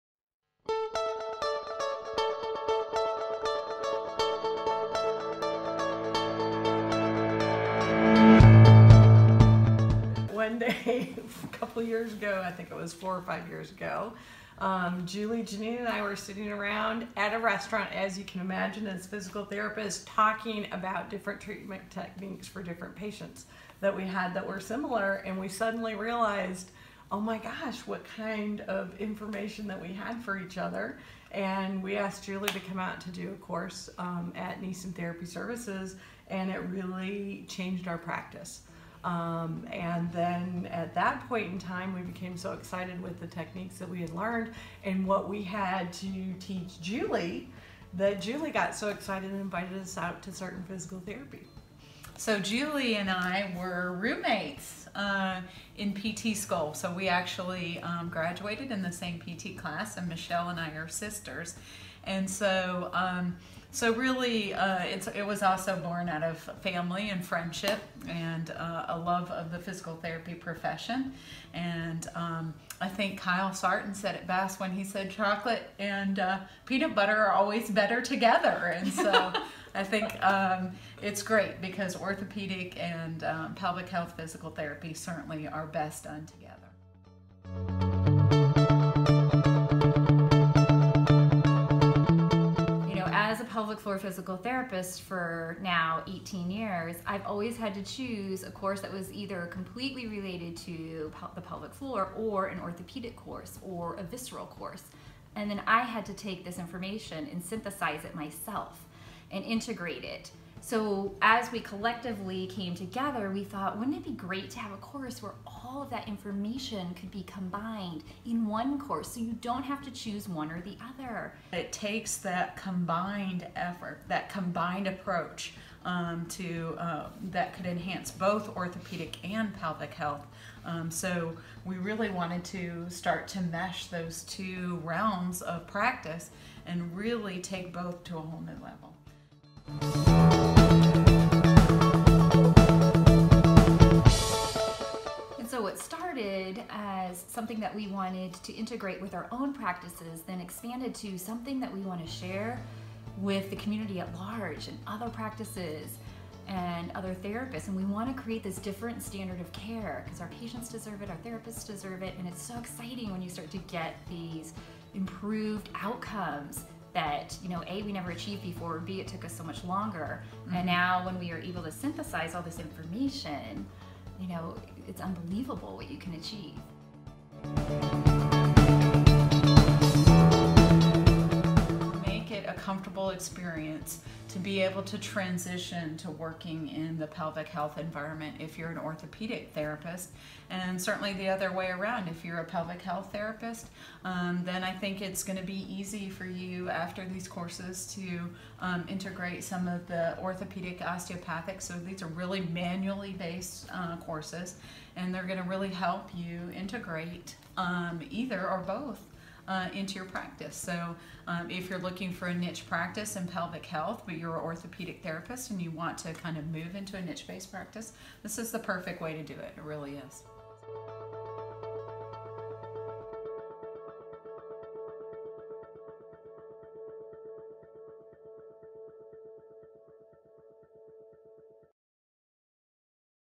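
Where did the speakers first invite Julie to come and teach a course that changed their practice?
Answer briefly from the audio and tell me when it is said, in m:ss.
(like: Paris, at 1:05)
Neeson Therapy Services, at 0:34.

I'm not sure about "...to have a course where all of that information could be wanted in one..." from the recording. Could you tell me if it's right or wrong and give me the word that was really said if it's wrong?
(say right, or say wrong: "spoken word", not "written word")
wrong: "combined", not "wanted".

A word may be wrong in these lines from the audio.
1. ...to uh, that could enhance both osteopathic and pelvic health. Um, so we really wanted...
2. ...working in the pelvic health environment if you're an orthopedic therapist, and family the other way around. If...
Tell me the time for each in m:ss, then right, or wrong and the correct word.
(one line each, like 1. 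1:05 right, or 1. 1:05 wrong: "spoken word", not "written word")
1. 2:06 wrong: "orthopedic", not "osteopathic"
2. 3:06 wrong: "certainly", not "family".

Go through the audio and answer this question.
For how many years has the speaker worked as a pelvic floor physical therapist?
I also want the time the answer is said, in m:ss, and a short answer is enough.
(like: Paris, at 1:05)
18, at 1:36.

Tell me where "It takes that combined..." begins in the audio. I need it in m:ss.
2:01.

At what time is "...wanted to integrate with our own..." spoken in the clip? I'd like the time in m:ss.
2:27.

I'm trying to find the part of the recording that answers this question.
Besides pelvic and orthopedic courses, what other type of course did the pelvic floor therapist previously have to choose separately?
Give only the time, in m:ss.
1:44.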